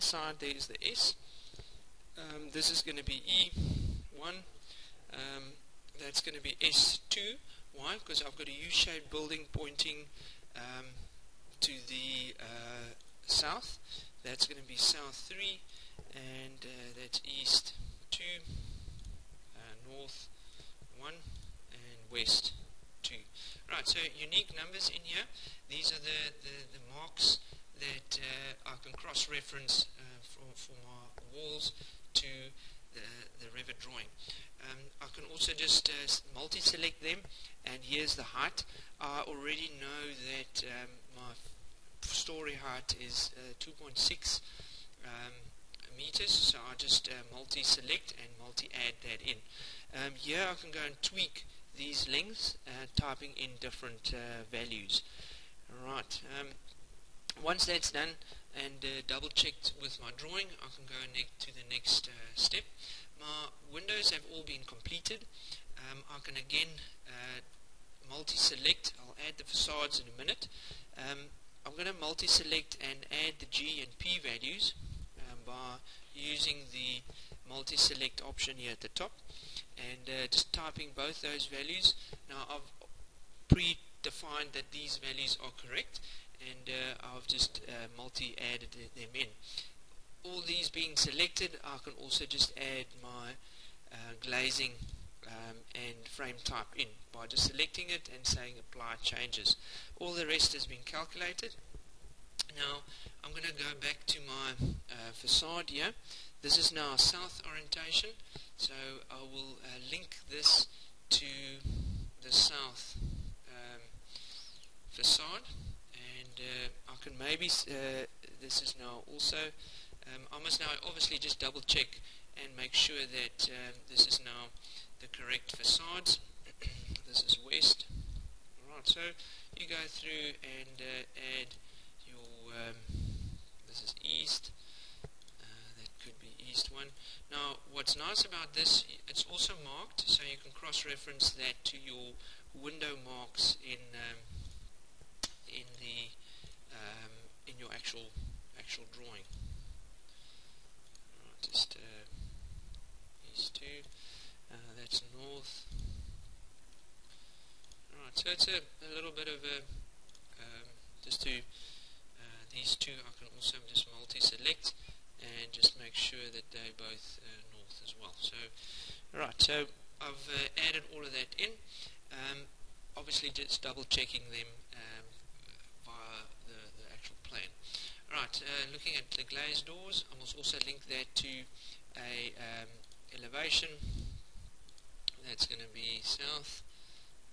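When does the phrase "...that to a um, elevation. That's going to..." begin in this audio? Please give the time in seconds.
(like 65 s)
180 s.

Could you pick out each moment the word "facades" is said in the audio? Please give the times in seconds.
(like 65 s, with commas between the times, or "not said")
69 s, 105 s, 125 s.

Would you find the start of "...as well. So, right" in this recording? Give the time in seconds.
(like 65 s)
167 s.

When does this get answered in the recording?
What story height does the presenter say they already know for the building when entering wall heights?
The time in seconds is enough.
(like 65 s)
43 s.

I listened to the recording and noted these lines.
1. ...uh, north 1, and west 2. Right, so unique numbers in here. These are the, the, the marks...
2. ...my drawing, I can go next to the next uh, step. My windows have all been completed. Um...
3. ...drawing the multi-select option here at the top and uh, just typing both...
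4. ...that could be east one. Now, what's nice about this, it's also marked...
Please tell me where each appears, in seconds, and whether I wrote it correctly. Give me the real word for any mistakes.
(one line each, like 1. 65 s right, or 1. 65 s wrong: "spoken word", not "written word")
1. 19 s right
2. 59 s right
3. 76 s wrong: "using", not "drawing"
4. 135 s right.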